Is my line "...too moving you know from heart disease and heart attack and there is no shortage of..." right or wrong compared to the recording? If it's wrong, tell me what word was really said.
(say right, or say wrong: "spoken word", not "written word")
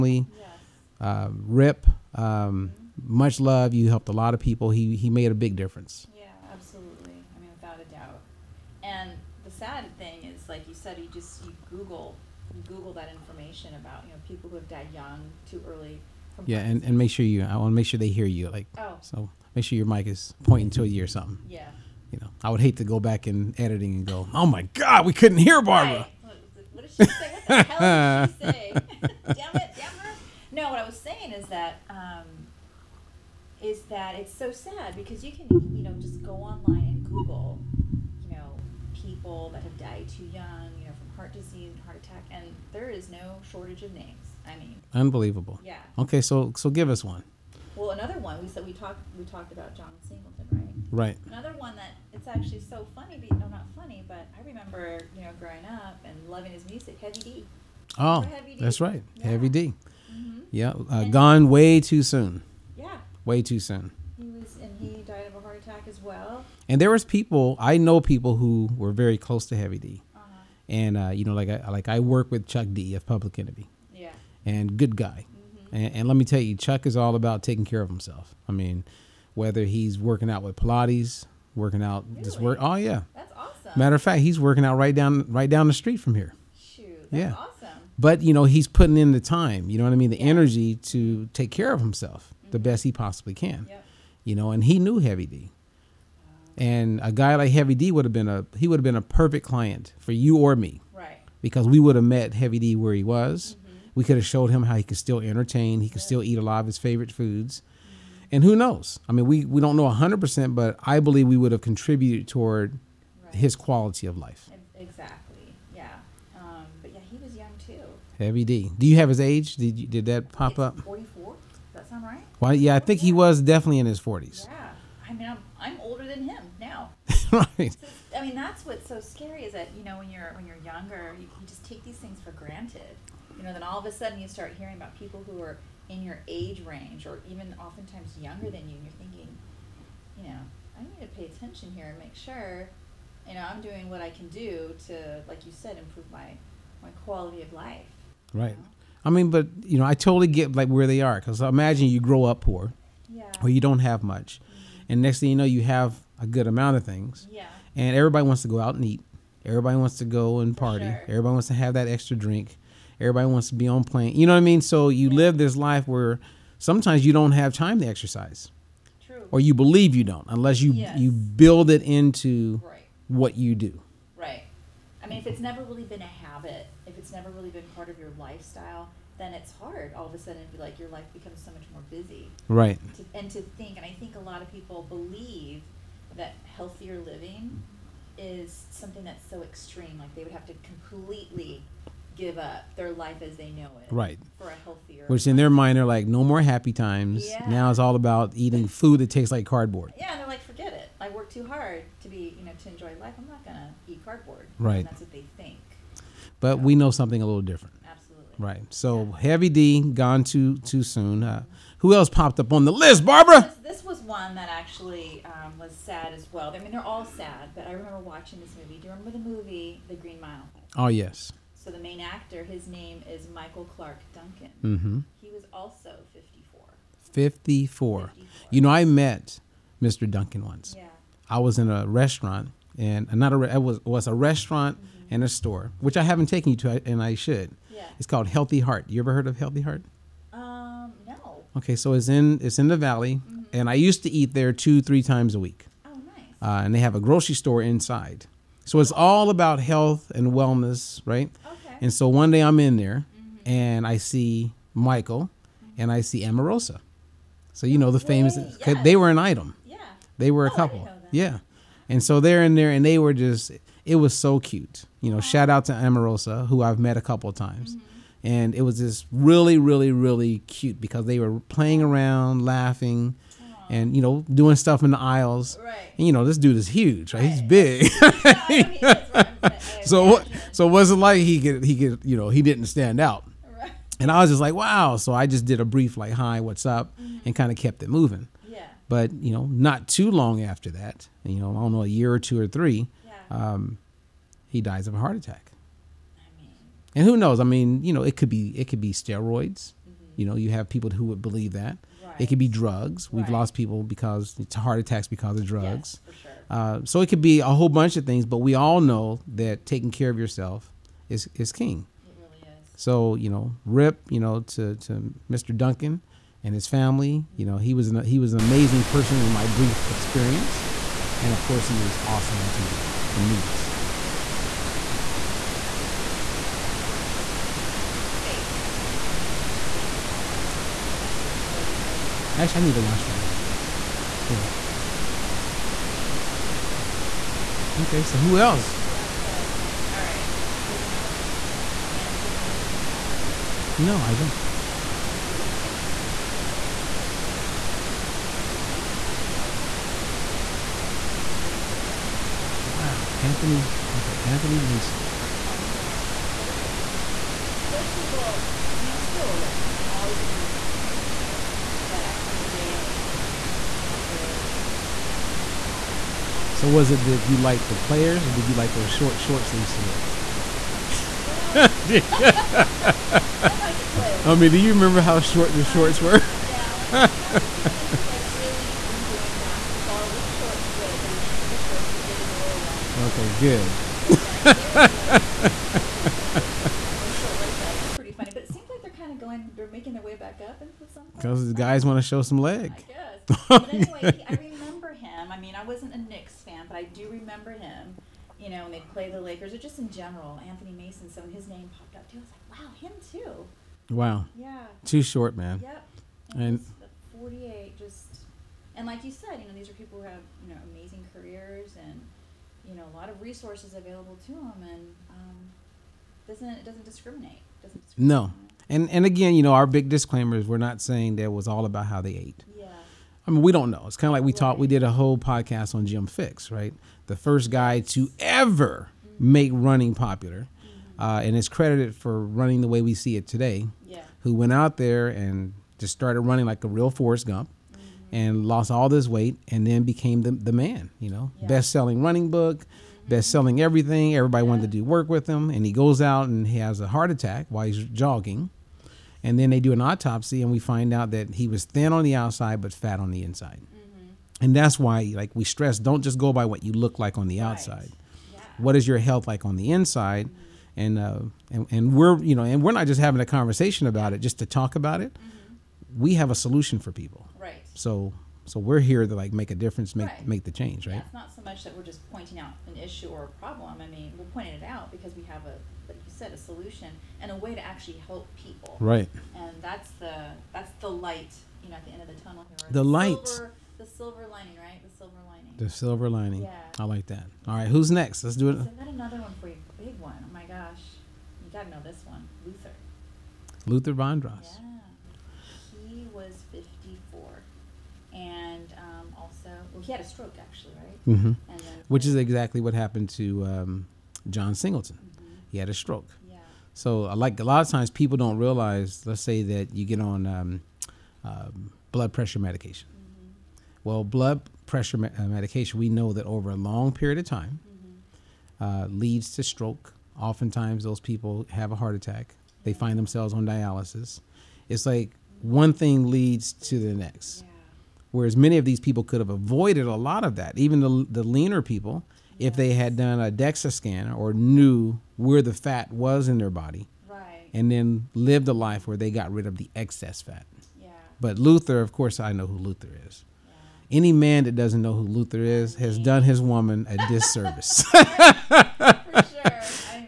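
wrong: "young", not "moving".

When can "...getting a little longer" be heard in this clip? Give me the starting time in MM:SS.
06:21.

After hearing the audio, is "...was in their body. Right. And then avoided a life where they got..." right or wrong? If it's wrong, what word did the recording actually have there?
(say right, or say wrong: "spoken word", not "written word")
wrong: "lived", not "avoided".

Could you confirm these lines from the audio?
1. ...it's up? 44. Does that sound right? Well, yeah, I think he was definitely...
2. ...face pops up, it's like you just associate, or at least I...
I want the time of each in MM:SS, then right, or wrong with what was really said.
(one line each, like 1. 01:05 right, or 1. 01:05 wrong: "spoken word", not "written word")
1. 02:00 right
2. 05:29 right.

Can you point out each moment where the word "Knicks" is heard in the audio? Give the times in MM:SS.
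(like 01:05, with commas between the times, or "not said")
05:47, 06:35.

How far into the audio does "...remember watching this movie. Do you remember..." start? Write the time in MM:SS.
03:37.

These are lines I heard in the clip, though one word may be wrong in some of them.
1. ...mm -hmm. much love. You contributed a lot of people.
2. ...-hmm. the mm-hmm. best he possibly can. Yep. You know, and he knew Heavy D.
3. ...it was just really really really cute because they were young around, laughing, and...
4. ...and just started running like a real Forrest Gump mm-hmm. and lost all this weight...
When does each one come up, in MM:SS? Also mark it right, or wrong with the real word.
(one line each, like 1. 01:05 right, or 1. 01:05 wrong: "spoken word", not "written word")
1. 00:02 wrong: "helped", not "contributed"
2. 01:32 right
3. 04:28 wrong: "playing", not "young"
4. 07:15 right.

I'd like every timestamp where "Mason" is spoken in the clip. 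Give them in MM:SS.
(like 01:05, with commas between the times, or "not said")
05:42, 05:54, 06:40.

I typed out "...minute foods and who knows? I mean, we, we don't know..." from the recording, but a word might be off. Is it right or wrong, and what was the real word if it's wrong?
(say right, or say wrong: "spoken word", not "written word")
wrong: "favorite", not "minute".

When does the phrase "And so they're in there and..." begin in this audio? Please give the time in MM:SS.
04:21.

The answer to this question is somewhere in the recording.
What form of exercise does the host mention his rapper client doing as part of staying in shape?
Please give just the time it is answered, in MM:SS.
01:20.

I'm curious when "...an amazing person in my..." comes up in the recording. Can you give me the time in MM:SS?
05:18.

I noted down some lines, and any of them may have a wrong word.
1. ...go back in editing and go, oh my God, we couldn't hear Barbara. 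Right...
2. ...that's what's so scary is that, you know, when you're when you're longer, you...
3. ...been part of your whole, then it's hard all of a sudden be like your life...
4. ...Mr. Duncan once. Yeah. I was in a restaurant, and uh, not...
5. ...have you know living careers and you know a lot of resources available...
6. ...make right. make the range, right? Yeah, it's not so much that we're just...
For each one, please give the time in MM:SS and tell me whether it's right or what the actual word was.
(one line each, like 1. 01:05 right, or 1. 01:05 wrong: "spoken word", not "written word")
1. 00:22 right
2. 02:08 wrong: "younger", not "longer"
3. 02:57 wrong: "lifestyle", not "whole"
4. 03:49 right
5. 06:50 wrong: "amazing", not "living"
6. 07:49 wrong: "change", not "range".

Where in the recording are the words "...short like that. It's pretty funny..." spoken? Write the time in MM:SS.
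06:27.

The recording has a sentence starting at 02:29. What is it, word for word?
i mean but you know i totally get like where they are because imagine you grow up poor yeah.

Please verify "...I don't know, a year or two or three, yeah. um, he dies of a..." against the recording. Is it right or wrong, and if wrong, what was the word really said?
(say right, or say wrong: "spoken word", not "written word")
right.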